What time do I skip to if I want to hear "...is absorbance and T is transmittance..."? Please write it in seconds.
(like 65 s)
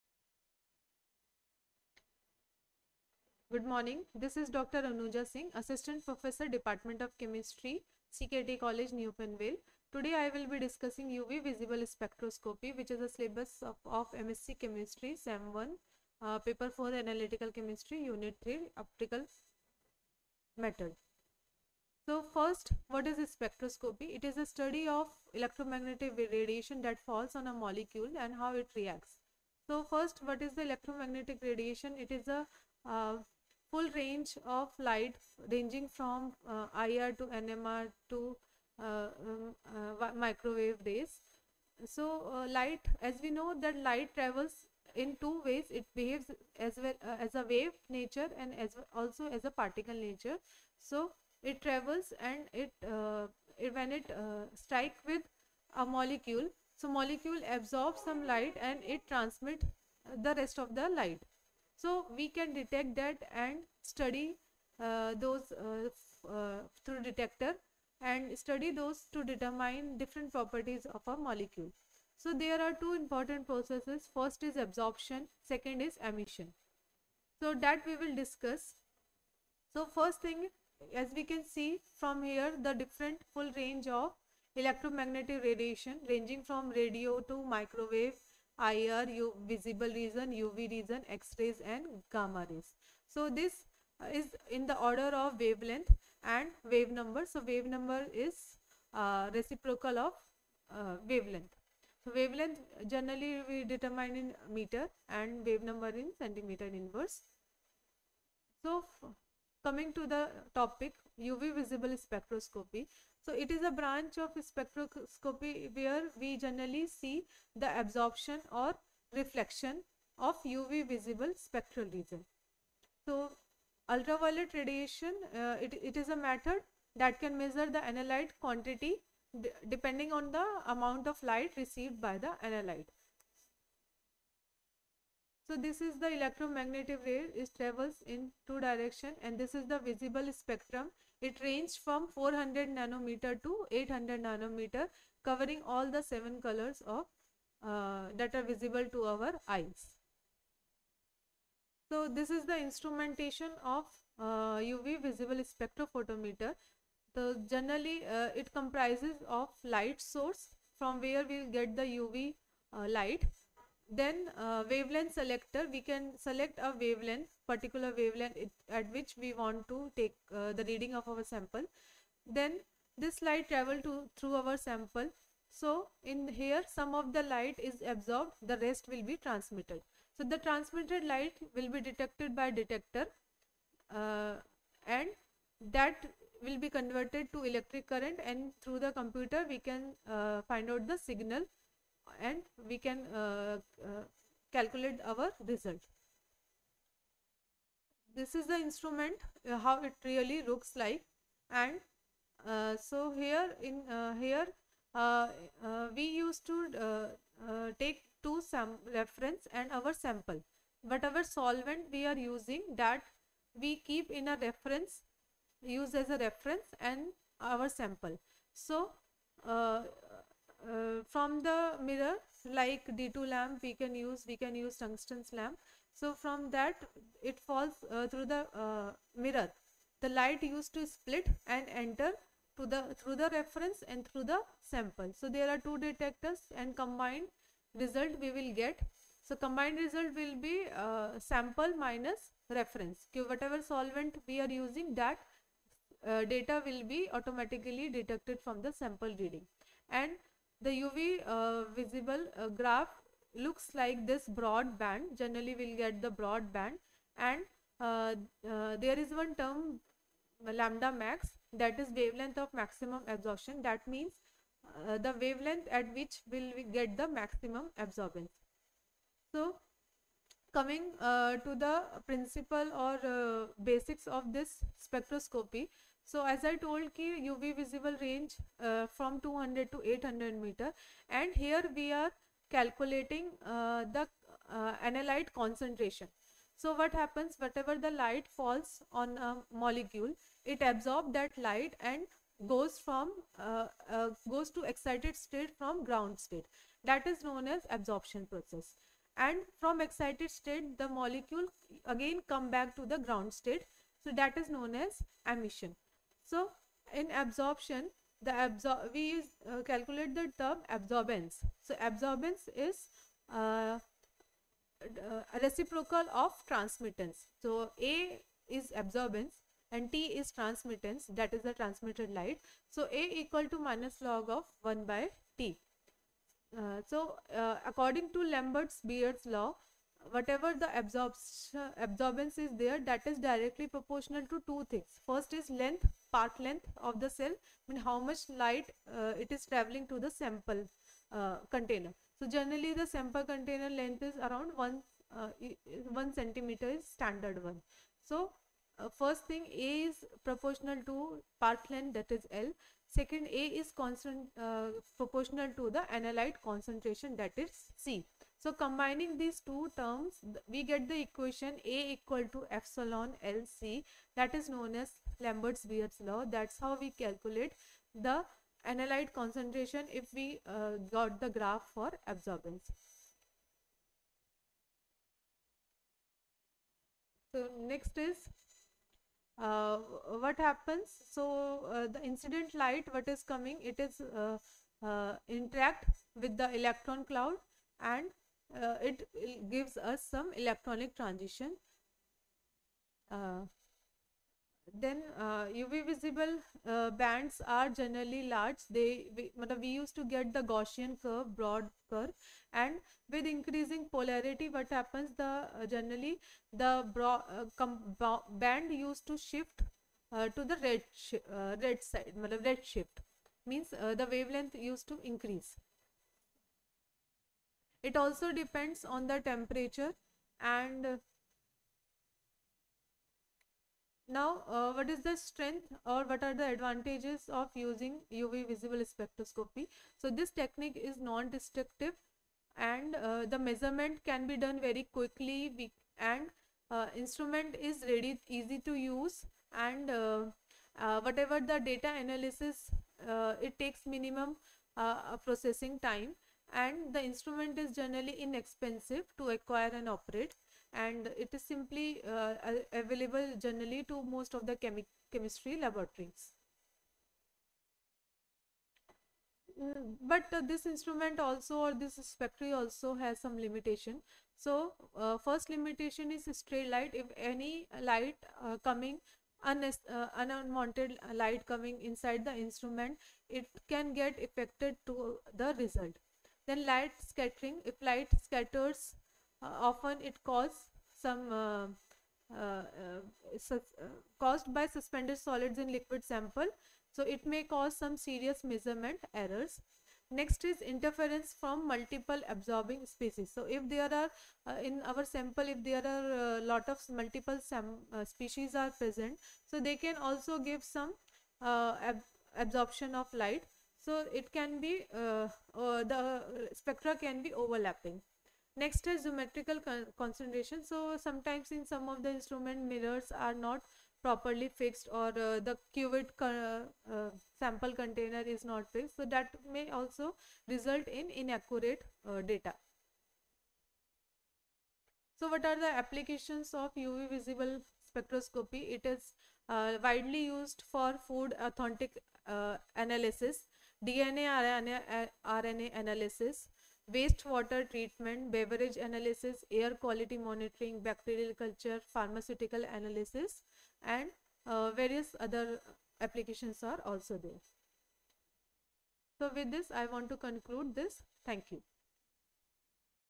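318 s.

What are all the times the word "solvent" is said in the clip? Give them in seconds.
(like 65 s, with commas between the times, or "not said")
211 s, 243 s.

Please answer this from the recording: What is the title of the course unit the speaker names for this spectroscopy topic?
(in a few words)
Optical Method.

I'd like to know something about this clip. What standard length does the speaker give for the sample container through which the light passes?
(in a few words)
1 centimeter.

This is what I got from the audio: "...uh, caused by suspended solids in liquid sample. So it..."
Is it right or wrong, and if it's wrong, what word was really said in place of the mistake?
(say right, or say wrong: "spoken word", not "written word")
right.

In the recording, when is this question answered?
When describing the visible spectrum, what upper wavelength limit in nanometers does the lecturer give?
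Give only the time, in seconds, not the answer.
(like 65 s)
143 s.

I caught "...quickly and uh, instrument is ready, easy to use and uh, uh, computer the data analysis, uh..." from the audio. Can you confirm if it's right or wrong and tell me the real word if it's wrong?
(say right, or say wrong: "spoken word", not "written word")
wrong: "whatever", not "computer".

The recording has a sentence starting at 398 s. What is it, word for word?
They we, we used to get the Gaussian curve, broad curve, and with increasing polarity, what happens?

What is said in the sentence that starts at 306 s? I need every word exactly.
So, in absorption, the absor we uh, calculate the term absorbance.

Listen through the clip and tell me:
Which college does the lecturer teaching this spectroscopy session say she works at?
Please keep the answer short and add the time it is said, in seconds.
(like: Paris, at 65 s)
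CKT College, at 8 s.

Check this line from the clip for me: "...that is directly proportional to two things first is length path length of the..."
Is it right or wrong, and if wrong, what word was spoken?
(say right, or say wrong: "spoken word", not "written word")
right.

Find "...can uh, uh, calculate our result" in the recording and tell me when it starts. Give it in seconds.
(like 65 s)
192 s.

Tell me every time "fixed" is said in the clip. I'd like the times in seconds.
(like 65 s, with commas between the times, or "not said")
514 s, 518 s.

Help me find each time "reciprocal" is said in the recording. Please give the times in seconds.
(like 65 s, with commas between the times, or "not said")
99 s, 315 s.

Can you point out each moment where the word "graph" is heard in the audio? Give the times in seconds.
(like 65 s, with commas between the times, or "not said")
252 s, 371 s.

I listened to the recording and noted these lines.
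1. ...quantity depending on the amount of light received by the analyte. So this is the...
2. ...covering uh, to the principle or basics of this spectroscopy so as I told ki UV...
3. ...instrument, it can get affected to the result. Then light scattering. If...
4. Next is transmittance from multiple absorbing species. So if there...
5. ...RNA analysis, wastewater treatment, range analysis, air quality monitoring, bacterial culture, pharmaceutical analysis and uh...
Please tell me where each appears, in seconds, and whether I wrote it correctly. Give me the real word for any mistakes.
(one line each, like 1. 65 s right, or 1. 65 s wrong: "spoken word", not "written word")
1. 128 s right
2. 270 s wrong: "coming", not "covering"
3. 472 s right
4. 490 s wrong: "interference", not "transmittance"
5. 535 s wrong: "beverage", not "range".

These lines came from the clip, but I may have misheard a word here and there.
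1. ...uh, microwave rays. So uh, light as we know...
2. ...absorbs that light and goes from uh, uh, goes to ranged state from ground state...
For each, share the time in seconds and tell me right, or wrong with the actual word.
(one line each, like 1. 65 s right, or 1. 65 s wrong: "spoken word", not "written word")
1. 39 s right
2. 290 s wrong: "excited", not "ranged".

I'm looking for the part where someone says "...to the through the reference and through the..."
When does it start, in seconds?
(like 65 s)
232 s.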